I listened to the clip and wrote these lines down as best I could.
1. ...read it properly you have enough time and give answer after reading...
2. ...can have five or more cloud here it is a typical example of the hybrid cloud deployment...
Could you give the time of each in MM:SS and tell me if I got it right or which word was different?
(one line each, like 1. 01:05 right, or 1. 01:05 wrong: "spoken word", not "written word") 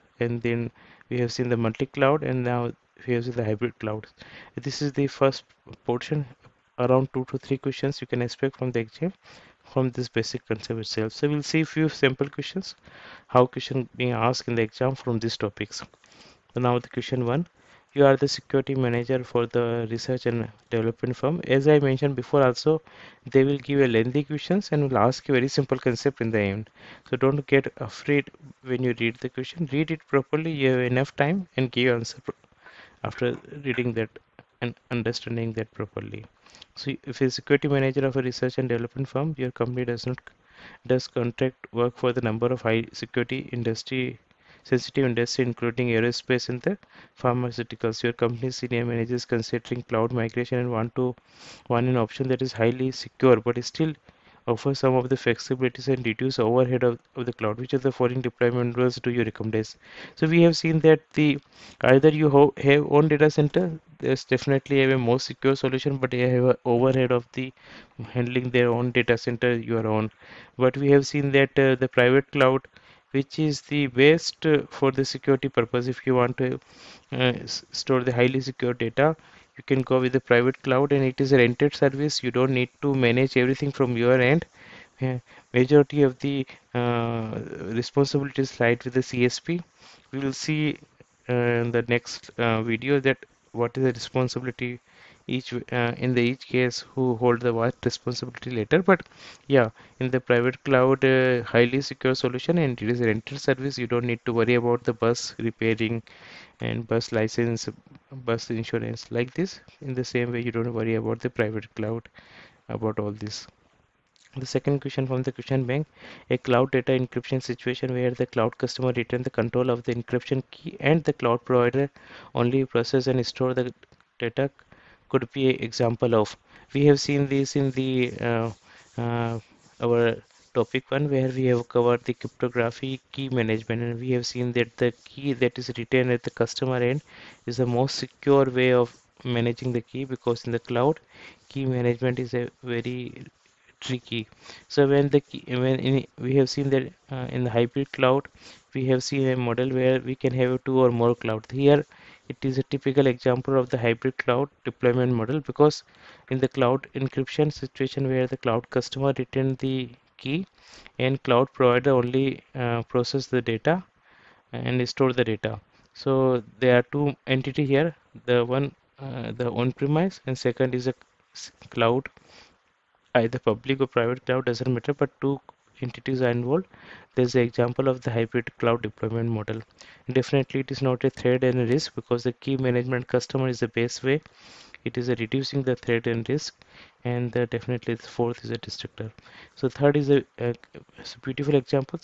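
1. 00:29 right
2. 02:30 wrong: "two", not "five".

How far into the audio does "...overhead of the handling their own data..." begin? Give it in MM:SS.
01:06.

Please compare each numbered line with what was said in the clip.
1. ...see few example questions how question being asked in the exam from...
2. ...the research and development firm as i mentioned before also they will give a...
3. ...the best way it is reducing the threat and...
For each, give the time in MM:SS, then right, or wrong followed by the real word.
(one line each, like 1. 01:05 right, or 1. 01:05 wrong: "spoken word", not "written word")
1. 00:11 wrong: "sample", not "example"
2. 00:19 right
3. 03:03 right.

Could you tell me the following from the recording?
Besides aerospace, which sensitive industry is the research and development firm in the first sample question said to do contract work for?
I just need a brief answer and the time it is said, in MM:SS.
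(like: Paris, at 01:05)
Pharmaceuticals, at 00:47.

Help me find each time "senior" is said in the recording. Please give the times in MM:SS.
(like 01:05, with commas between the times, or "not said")
00:48.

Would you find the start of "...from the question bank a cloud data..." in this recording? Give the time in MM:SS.
01:55.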